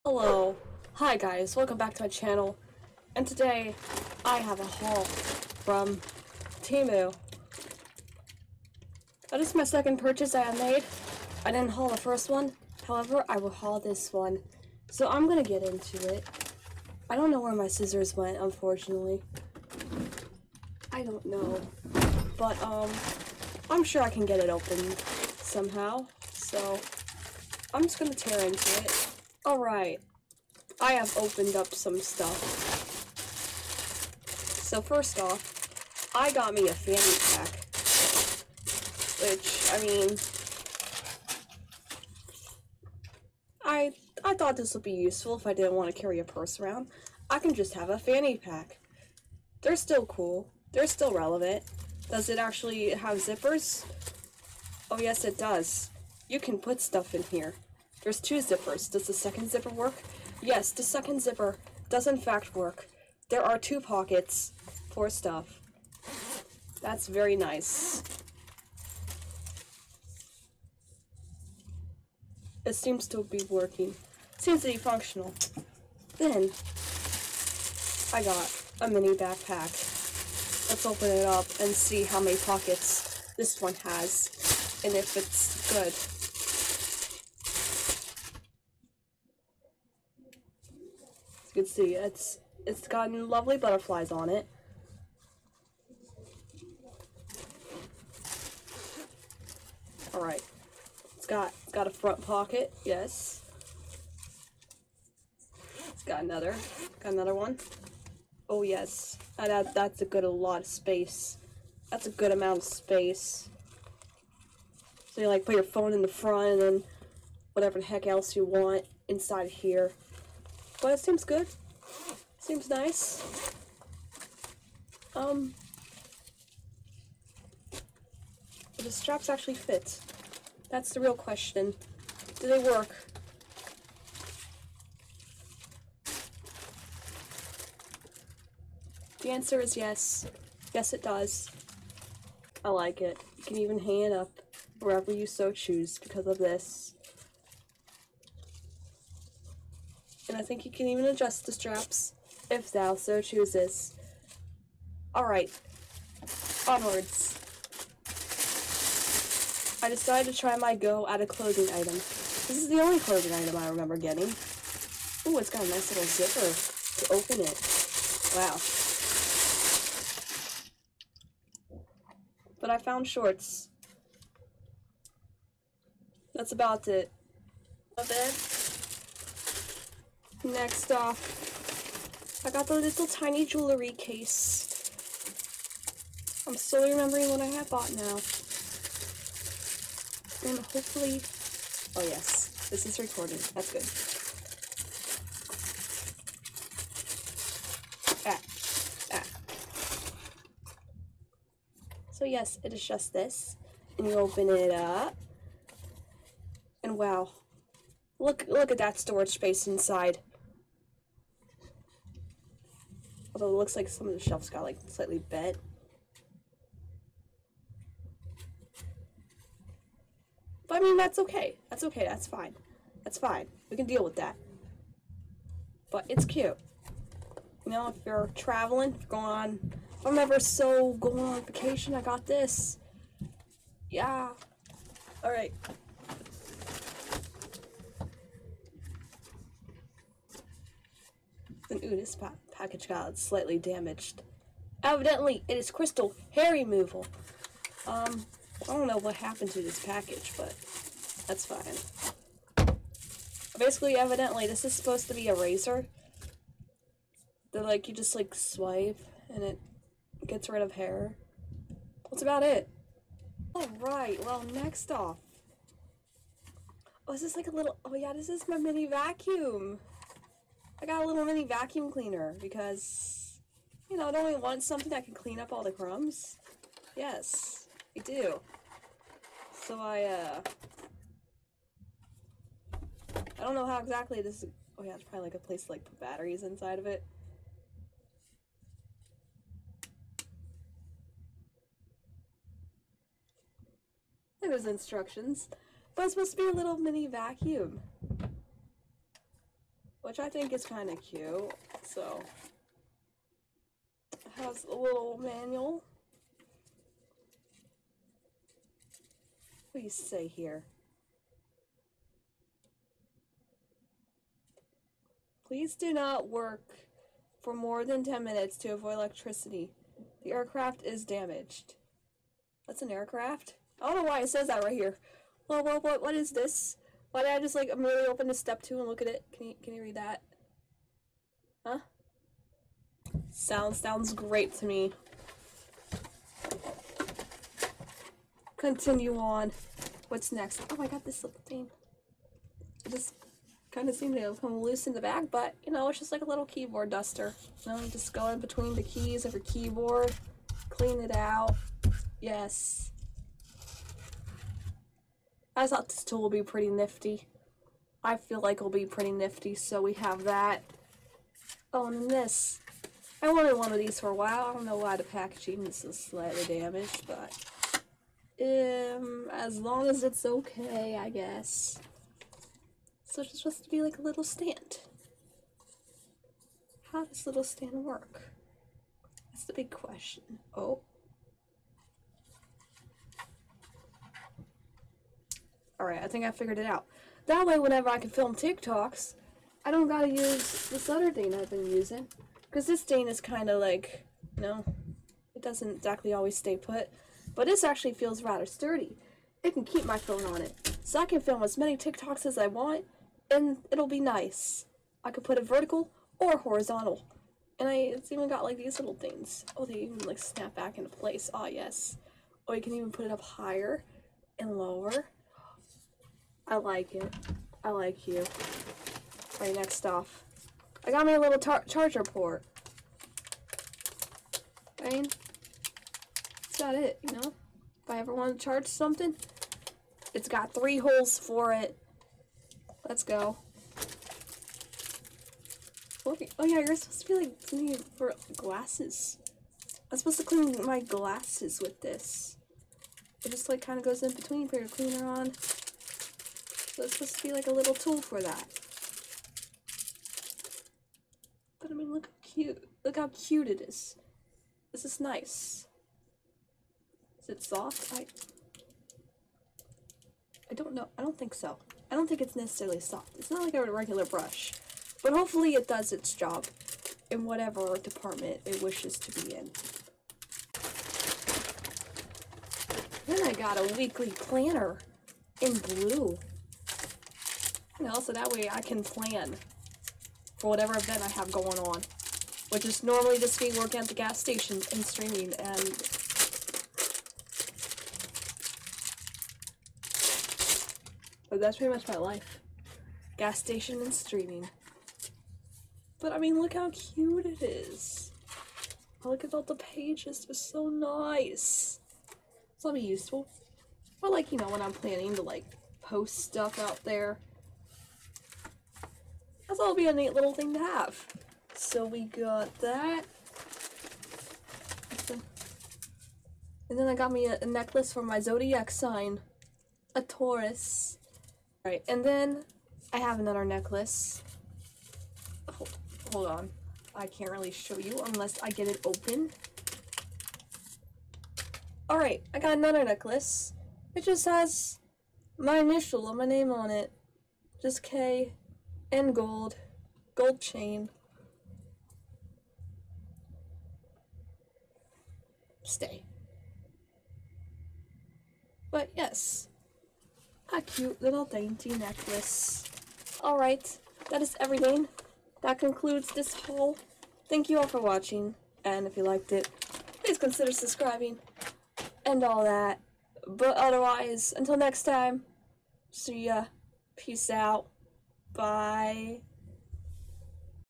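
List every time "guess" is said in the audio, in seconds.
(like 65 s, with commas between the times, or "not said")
371 s.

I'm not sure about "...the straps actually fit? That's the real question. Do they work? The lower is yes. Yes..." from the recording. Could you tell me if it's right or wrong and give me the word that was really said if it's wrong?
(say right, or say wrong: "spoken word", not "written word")
wrong: "answer", not "lower".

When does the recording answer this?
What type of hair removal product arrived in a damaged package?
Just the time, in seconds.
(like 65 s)
245 s.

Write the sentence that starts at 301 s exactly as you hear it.
So, it has a little manual.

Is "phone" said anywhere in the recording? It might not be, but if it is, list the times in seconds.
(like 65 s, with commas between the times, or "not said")
115 s, 399 s.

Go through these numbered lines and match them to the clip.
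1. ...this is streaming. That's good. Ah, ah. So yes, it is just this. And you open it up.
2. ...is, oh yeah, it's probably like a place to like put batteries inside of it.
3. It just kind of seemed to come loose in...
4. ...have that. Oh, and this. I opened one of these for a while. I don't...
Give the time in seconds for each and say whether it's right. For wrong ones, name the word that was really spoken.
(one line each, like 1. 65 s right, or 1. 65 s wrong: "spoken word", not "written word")
1. 192 s wrong: "recording", not "streaming"
2. 284 s right
3. 342 s right
4. 359 s wrong: "wanted", not "opened".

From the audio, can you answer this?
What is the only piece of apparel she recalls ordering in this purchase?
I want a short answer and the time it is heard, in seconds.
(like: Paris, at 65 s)
Shorts, at 173 s.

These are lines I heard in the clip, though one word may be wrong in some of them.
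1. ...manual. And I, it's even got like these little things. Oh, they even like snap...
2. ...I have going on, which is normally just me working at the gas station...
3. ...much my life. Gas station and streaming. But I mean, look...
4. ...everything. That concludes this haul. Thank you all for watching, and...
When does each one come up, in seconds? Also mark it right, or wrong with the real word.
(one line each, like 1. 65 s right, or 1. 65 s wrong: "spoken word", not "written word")
1. 406 s wrong: "horizontal", not "manual"
2. 481 s right
3. 491 s right
4. 554 s right.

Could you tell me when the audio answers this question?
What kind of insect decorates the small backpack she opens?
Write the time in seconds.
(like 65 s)
93 s.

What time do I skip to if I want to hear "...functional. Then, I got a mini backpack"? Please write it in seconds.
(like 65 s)
74 s.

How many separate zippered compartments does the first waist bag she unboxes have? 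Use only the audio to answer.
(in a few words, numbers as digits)
2.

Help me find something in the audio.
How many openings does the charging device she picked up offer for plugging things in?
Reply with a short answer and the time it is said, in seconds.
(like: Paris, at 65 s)
3, at 430 s.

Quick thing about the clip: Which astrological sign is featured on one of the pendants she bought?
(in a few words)
Taurus.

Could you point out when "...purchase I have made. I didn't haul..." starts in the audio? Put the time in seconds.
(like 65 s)
9 s.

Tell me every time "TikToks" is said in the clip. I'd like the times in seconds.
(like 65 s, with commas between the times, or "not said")
388 s, 401 s.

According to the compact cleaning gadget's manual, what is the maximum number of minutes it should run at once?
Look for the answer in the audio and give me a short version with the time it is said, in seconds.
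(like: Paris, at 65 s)
10, at 318 s.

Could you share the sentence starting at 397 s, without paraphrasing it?
But this actually feels rather sturdy.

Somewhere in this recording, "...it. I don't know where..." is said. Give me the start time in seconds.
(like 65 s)
16 s.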